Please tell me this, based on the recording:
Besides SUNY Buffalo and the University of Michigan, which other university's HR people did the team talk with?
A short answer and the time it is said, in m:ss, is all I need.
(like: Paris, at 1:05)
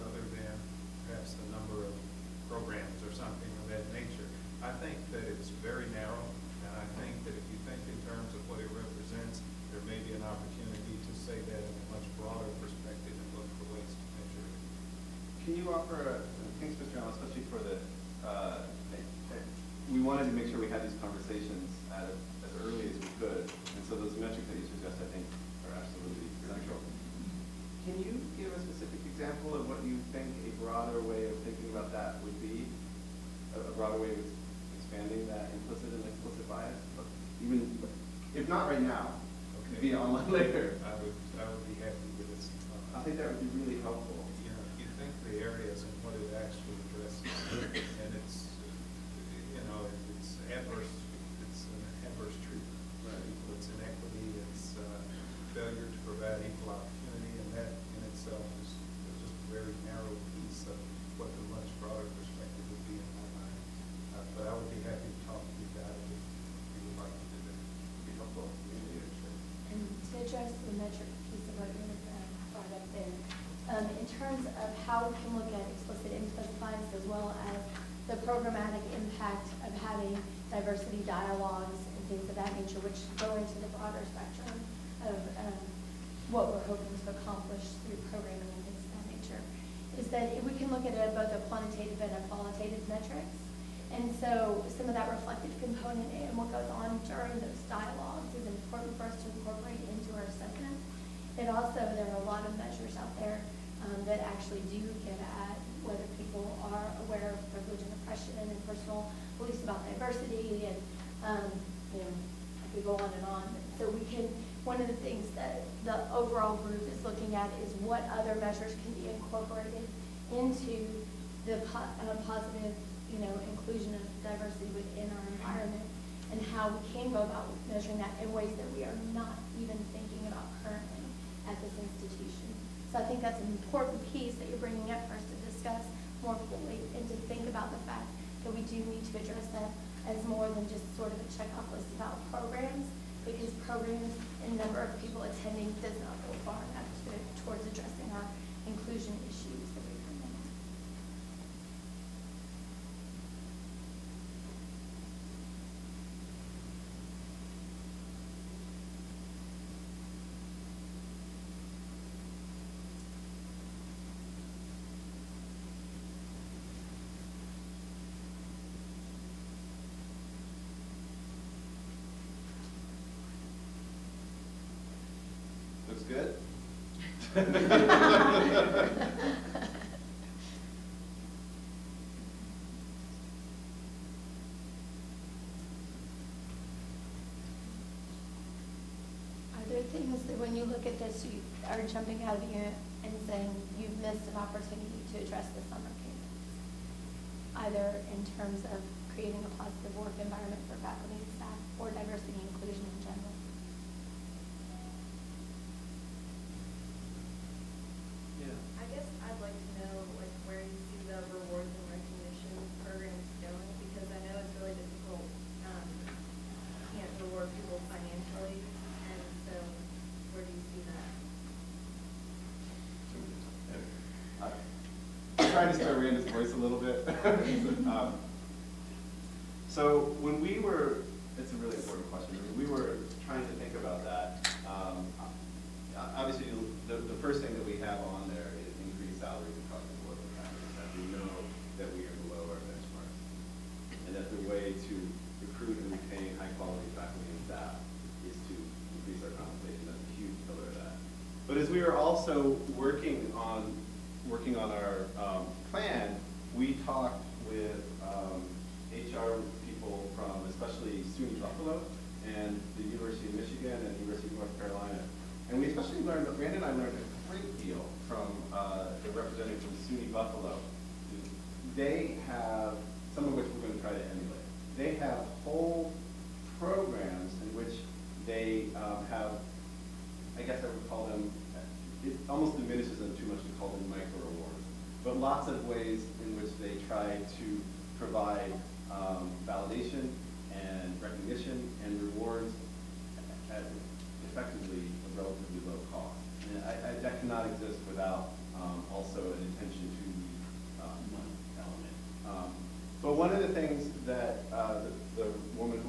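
University of North Carolina, at 4:24.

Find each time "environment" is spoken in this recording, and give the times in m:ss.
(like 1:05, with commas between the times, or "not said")
2:05, 3:20.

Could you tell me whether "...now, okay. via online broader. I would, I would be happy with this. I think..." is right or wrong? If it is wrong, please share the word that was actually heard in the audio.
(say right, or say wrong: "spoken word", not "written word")
wrong: "later", not "broader".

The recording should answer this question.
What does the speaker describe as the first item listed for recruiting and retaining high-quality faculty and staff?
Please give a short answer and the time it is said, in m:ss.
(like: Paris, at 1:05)
increased salaries, at 3:58.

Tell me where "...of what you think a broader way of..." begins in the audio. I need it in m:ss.
0:29.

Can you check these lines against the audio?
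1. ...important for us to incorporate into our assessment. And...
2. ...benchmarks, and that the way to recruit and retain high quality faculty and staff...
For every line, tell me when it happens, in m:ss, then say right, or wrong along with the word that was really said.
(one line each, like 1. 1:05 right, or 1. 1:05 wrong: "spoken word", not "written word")
1. 1:38 right
2. 4:02 right.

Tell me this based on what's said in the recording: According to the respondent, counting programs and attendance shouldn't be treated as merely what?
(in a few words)
a checkoff list.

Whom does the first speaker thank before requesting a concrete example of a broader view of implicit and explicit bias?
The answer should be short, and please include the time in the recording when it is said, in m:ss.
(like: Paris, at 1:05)
Mr. Allen, at 0:16.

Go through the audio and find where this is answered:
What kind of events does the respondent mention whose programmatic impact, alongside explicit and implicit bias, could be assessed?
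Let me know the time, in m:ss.
1:20.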